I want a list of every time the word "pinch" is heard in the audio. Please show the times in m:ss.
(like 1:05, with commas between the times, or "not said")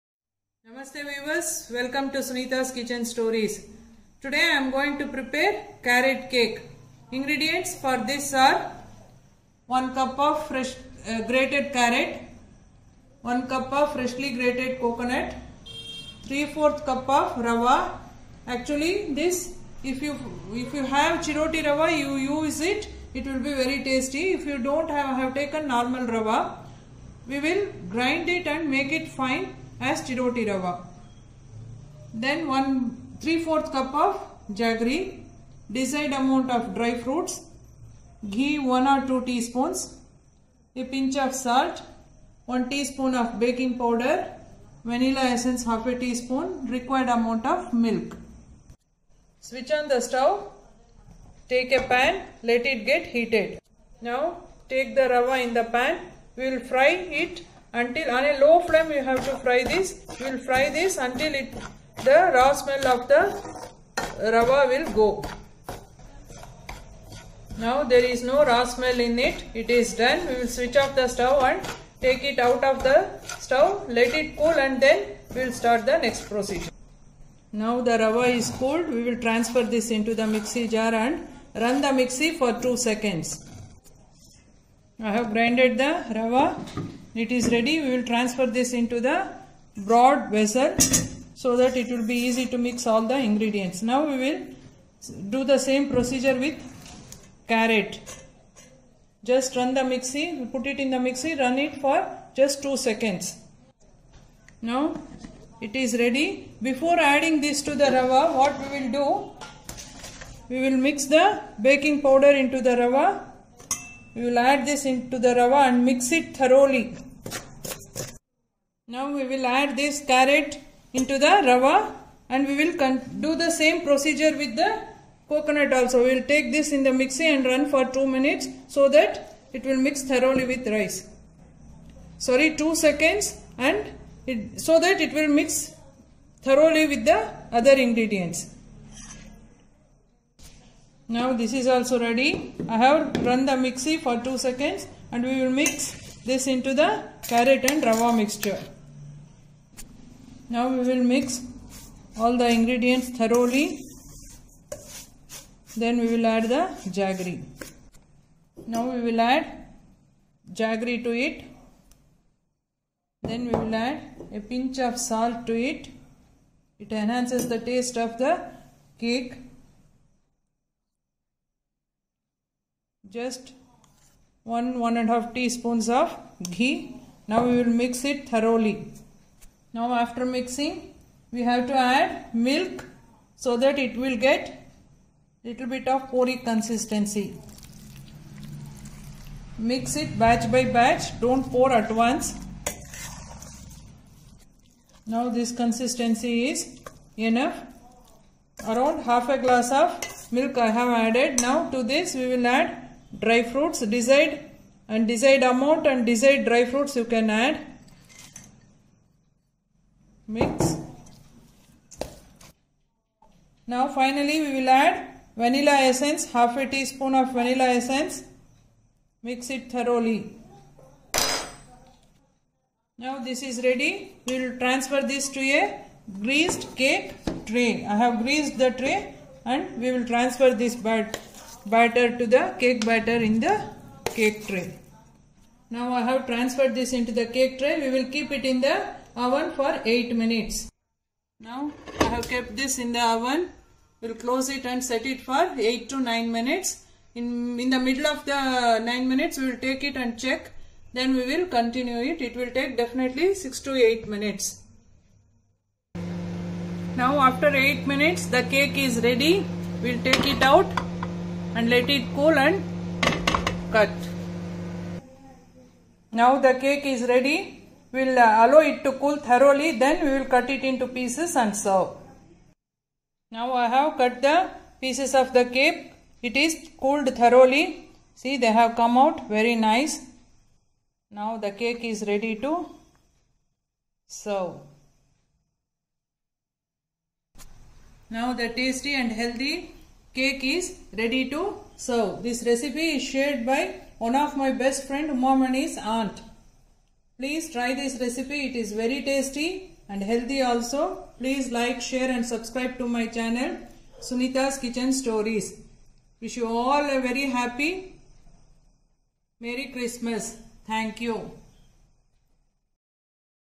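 0:40, 2:44.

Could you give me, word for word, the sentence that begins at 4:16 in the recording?
Now after 8 minutes the cake is ready.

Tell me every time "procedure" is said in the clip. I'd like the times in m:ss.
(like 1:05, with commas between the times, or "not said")
1:16, 1:35, 2:03.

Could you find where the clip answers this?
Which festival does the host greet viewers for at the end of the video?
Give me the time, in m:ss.
5:09.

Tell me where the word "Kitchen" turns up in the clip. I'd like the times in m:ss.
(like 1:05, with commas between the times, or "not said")
0:02, 5:04.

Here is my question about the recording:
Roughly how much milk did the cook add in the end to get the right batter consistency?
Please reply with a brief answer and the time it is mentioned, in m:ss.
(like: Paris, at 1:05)
half a glass, at 3:19.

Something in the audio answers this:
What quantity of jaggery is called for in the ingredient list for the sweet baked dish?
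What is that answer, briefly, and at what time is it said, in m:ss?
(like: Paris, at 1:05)
1/3 cup, at 0:32.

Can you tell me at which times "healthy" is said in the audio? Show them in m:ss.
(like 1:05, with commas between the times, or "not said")
4:49, 5:00.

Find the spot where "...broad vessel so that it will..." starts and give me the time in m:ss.
1:29.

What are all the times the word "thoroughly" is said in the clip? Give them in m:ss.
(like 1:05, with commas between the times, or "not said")
1:56, 2:10, 2:16, 2:33, 2:58, 3:39, 4:29, 4:37.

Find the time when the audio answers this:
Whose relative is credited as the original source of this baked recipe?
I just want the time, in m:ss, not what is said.
4:55.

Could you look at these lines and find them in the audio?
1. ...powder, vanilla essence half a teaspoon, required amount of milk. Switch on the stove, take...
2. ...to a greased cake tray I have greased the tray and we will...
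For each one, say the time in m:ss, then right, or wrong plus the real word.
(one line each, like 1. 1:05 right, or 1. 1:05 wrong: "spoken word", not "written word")
1. 0:43 right
2. 3:45 right.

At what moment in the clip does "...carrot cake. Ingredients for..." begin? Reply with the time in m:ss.
0:05.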